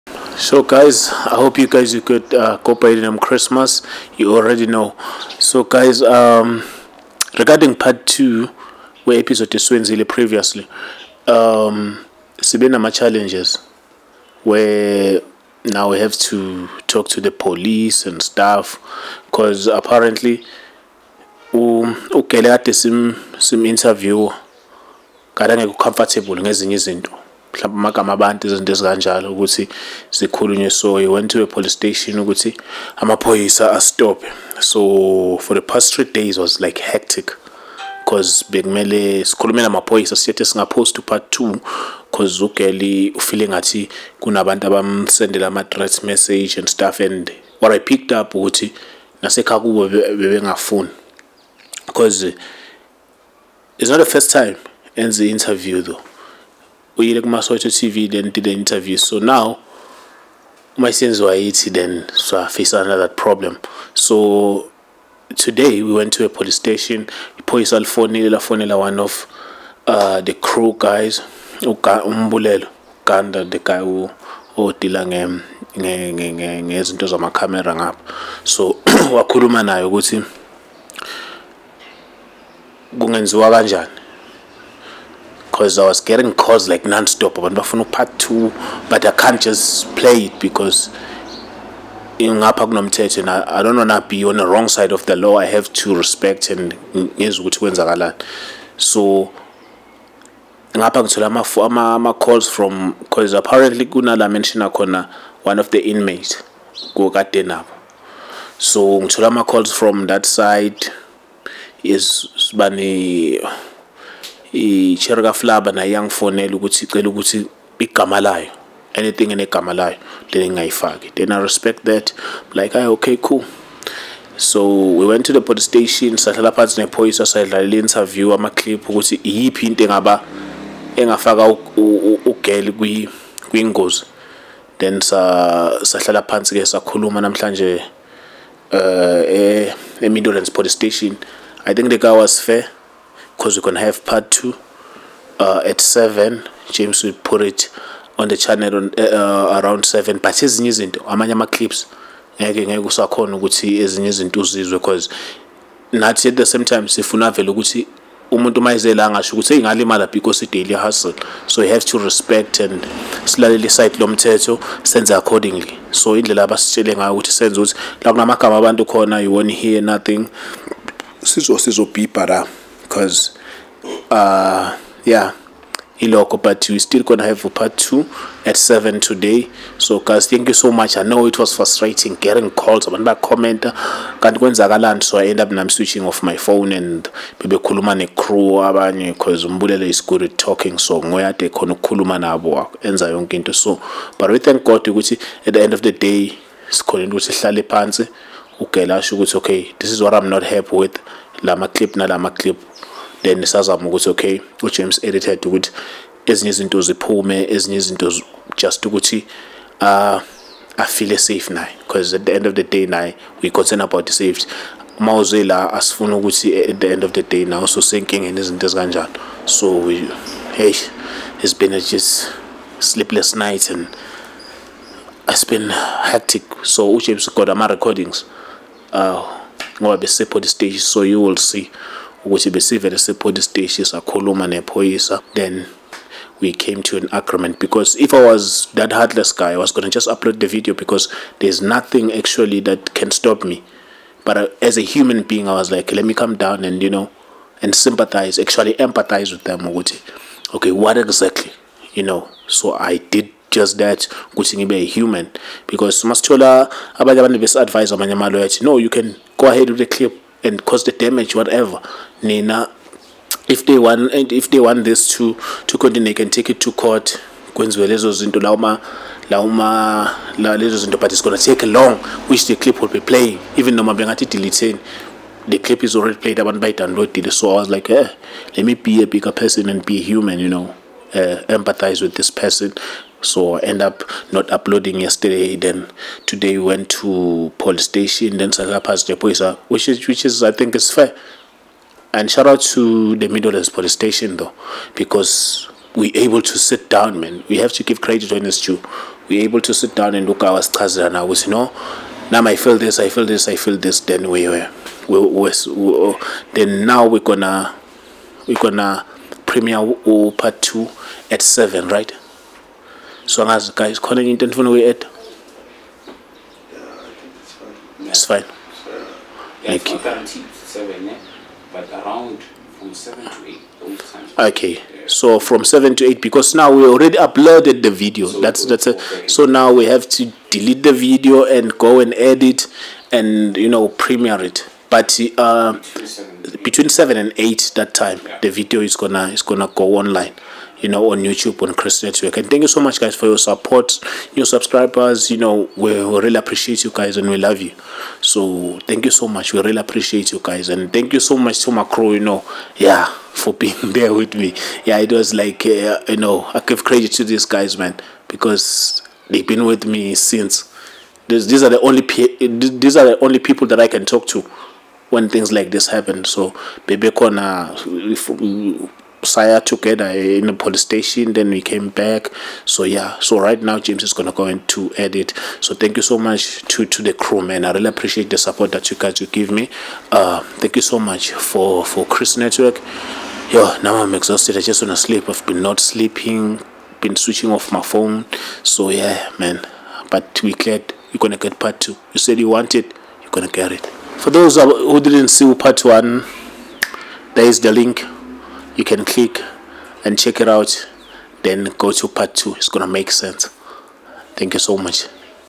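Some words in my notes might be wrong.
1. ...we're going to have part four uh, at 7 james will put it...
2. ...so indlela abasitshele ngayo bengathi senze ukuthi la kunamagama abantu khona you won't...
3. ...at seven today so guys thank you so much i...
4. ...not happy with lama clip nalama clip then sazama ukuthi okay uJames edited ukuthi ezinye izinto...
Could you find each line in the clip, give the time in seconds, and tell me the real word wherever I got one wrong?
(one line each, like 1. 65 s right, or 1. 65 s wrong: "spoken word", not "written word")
1. 143 s wrong: "two", not "four"
2. 165 s wrong: "ukuthi", not "bengathi"
3. 178 s right
4. 200 s right.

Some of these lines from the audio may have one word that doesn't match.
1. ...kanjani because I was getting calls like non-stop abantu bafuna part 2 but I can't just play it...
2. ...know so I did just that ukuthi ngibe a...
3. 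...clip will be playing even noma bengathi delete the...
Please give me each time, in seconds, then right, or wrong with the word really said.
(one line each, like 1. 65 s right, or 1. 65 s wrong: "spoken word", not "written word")
1. 83 s right
2. 252 s right
3. 272 s right.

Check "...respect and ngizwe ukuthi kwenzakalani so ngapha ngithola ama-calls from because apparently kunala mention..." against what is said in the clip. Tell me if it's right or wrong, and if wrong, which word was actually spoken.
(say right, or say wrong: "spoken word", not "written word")
right.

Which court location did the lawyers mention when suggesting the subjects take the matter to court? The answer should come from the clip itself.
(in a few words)
Queensville.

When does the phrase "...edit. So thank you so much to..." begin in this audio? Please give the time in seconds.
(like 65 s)
374 s.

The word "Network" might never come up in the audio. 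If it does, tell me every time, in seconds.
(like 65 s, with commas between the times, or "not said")
342 s, 382 s.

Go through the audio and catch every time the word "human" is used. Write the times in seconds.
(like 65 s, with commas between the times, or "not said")
244 s, 254 s, 280 s.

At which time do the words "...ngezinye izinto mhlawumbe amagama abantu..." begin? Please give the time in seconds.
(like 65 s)
26 s.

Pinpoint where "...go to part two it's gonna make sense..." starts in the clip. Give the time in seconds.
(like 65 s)
401 s.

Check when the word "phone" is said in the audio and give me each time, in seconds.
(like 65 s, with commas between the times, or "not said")
186 s, 387 s.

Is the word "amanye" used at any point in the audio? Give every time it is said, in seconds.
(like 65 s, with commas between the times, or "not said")
151 s, 257 s.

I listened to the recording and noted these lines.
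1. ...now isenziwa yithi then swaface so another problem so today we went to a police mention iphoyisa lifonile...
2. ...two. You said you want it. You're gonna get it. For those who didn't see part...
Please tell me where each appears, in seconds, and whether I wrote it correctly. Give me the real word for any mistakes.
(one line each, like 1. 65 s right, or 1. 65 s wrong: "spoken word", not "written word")
1. 59 s wrong: "station", not "mention"
2. 391 s right.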